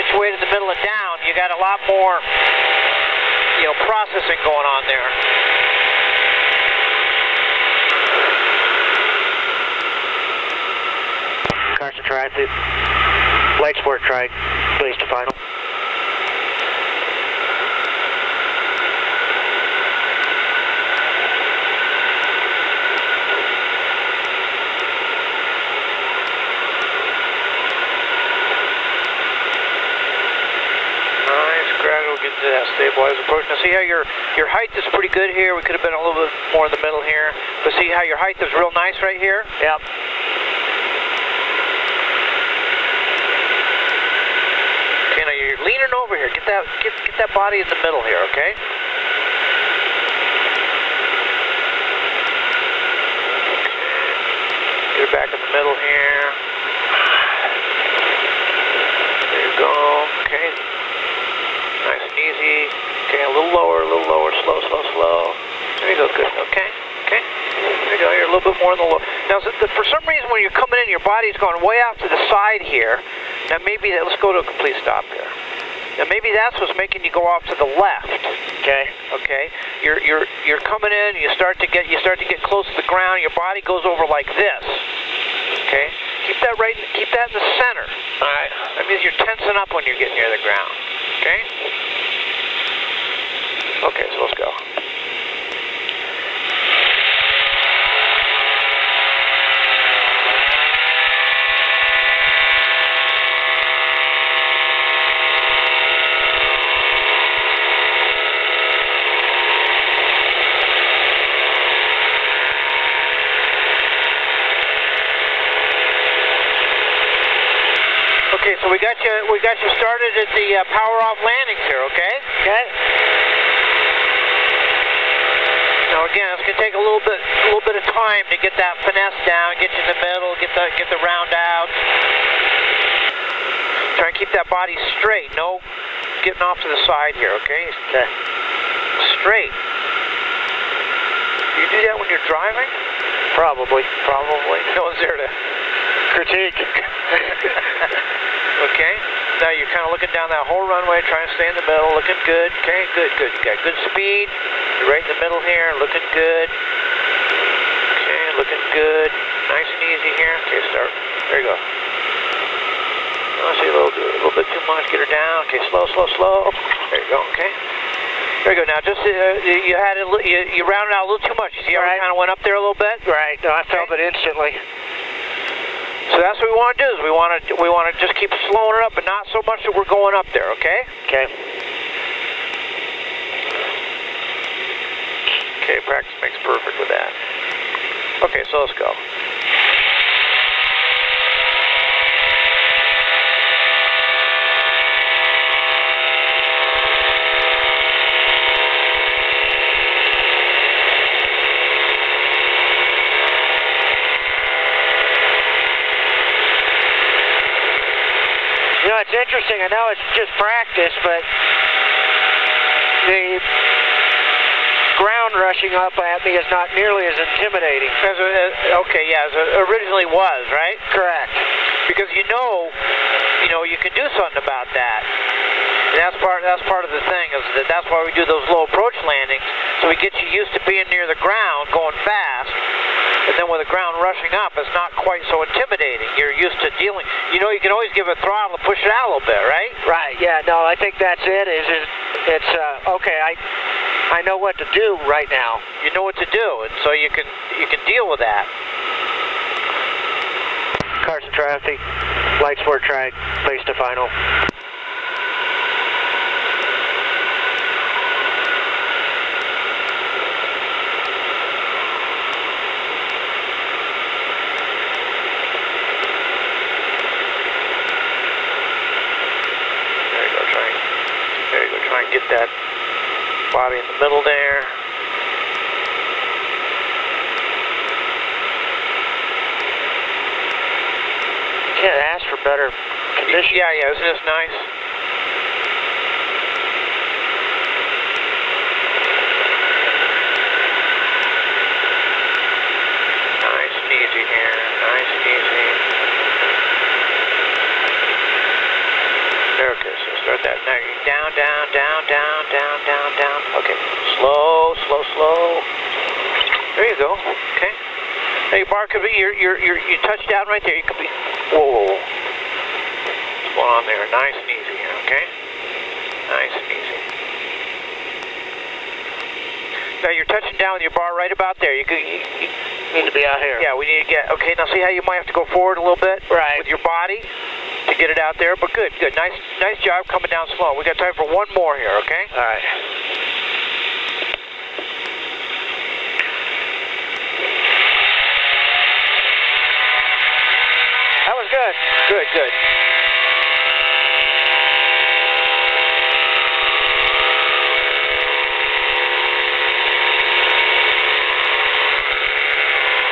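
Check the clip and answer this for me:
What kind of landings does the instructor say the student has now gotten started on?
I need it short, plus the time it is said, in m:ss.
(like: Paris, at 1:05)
power off landings, at 2:00.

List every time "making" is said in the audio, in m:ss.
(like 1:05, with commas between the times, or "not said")
1:16.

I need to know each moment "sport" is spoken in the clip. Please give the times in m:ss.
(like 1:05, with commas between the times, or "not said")
0:13, 4:12.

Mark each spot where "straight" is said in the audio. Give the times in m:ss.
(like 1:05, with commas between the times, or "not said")
2:14, 2:19.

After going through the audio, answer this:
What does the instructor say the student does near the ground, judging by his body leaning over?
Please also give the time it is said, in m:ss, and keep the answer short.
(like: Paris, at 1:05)
tensing up, at 1:29.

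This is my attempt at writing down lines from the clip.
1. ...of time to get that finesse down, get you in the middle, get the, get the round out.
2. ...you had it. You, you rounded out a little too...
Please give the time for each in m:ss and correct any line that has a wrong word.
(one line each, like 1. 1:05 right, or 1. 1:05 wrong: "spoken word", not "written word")
1. 2:07 right
2. 2:49 right.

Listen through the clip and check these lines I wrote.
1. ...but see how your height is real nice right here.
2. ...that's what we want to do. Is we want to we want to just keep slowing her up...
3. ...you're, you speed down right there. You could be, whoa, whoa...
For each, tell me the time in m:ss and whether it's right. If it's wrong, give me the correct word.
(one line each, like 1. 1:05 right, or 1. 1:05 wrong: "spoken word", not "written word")
1. 0:37 right
2. 2:56 right
3. 5:09 wrong: "touched", not "speed".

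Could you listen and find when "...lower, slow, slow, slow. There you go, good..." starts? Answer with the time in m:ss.
1:04.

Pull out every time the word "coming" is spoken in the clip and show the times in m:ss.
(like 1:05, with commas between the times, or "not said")
1:10, 1:20, 5:30.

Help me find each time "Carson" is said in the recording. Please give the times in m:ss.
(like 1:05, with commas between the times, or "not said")
0:11, 4:11.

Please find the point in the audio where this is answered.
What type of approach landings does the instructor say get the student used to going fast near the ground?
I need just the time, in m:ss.
3:48.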